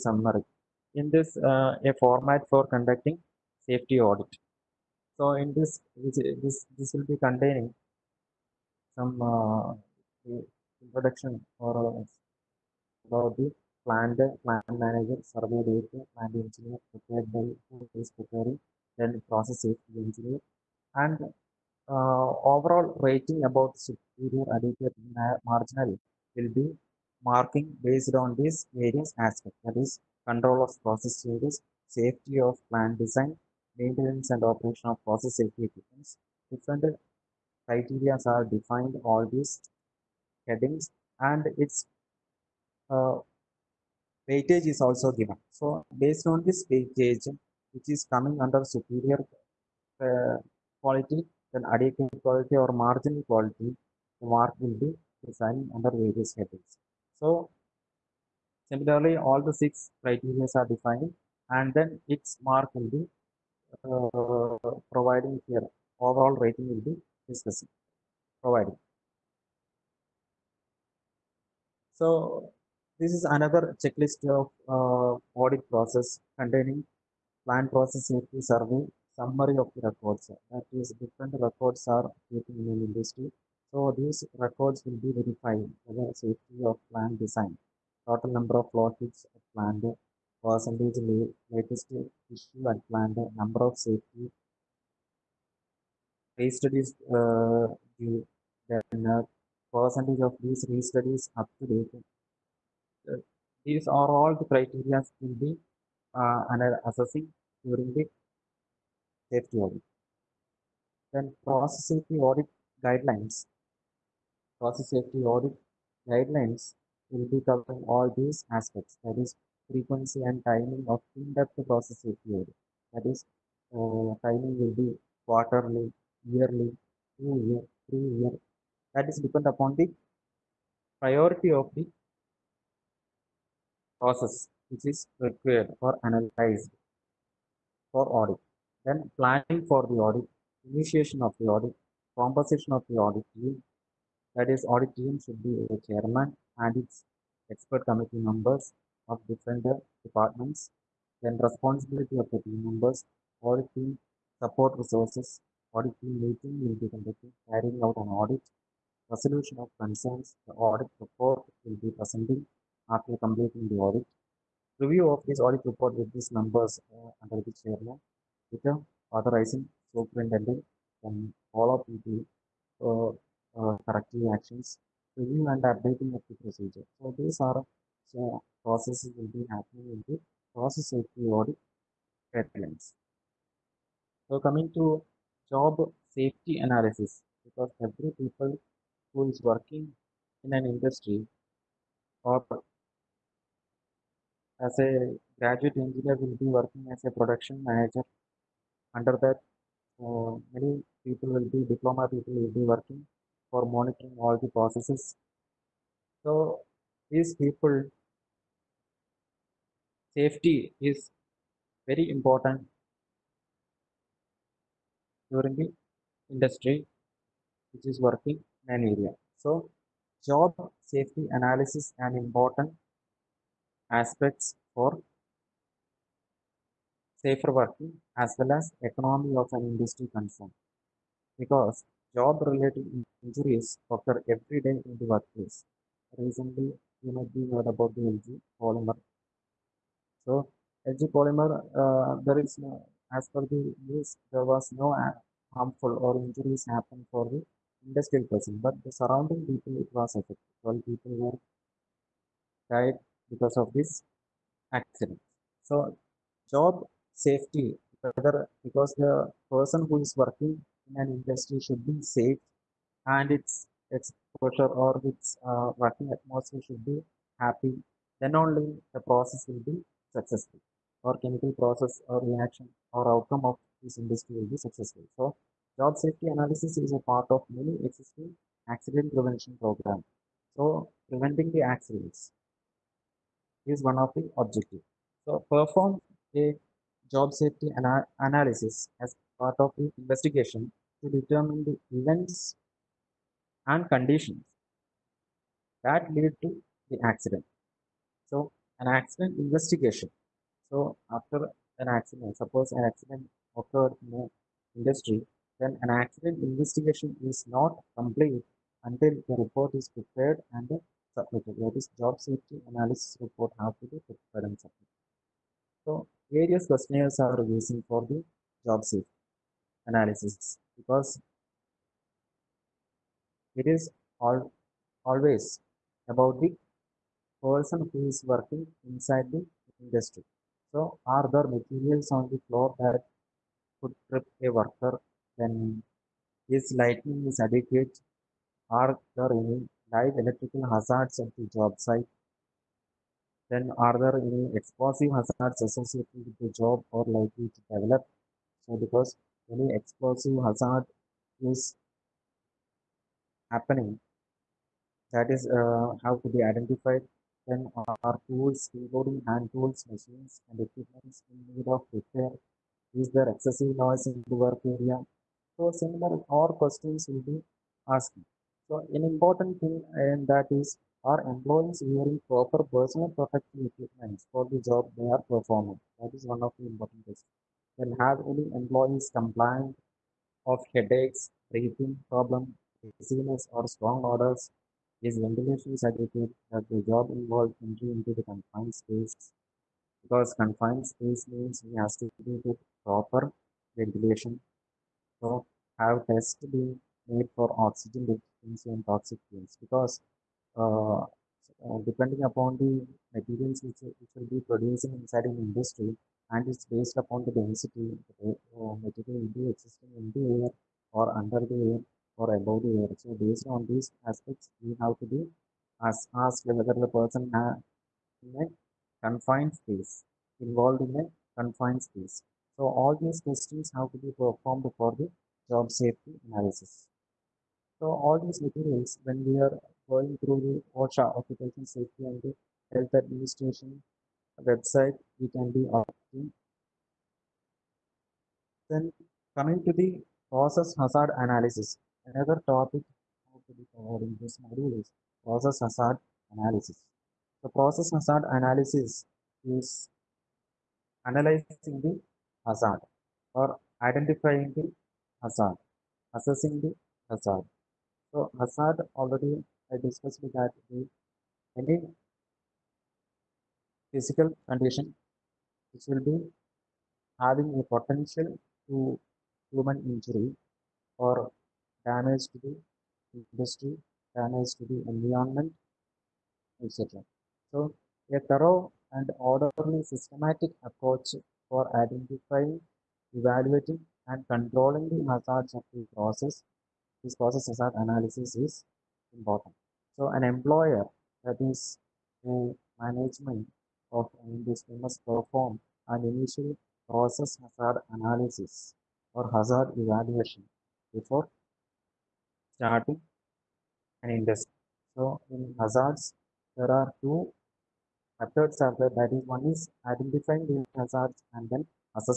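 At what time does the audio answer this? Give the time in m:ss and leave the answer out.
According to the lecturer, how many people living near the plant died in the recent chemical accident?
4:10.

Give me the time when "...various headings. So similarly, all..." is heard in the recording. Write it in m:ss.
0:55.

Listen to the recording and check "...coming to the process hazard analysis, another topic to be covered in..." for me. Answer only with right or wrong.
right.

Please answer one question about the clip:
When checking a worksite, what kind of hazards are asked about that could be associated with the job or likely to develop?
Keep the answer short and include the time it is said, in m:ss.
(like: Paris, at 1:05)
Explosive hazards, at 5:44.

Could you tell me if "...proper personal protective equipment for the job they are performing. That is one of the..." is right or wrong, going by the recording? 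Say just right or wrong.
right.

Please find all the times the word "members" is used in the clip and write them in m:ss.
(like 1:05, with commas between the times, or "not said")
2:28, 2:32.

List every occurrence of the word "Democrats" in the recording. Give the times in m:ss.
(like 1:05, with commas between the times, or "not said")
not said.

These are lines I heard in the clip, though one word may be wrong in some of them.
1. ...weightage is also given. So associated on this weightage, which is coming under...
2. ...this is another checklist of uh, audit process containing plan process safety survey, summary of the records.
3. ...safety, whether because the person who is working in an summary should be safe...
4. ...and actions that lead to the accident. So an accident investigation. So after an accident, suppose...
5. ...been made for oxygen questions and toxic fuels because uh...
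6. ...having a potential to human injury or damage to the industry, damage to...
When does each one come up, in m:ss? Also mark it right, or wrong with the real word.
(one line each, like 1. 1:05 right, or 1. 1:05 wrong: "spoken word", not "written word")
1. 0:44 wrong: "based", not "associated"
2. 1:13 right
3. 4:17 wrong: "industry", not "summary"
4. 4:53 wrong: "conditions", not "actions"
5. 6:36 wrong: "toxins", not "questions"
6. 7:47 right.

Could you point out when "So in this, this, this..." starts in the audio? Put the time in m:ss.
0:05.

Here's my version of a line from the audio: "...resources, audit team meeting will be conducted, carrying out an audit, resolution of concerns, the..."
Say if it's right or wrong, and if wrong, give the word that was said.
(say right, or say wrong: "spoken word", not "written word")
right.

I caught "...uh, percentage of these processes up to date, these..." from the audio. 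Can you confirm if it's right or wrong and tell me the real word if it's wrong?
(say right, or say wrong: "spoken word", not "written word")
wrong: "studies", not "processes".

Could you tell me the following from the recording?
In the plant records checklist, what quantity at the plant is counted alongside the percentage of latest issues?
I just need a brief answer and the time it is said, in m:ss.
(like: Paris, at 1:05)
Total number of flowsheets, at 1:28.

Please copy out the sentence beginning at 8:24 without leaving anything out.
So in hazards, there are two methods are there.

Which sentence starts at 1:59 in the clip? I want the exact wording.
That is frequency and timing of in-depth process safety audit.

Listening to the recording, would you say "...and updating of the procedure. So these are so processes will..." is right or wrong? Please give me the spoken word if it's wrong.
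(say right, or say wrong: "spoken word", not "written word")
right.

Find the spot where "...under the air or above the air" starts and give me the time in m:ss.
6:51.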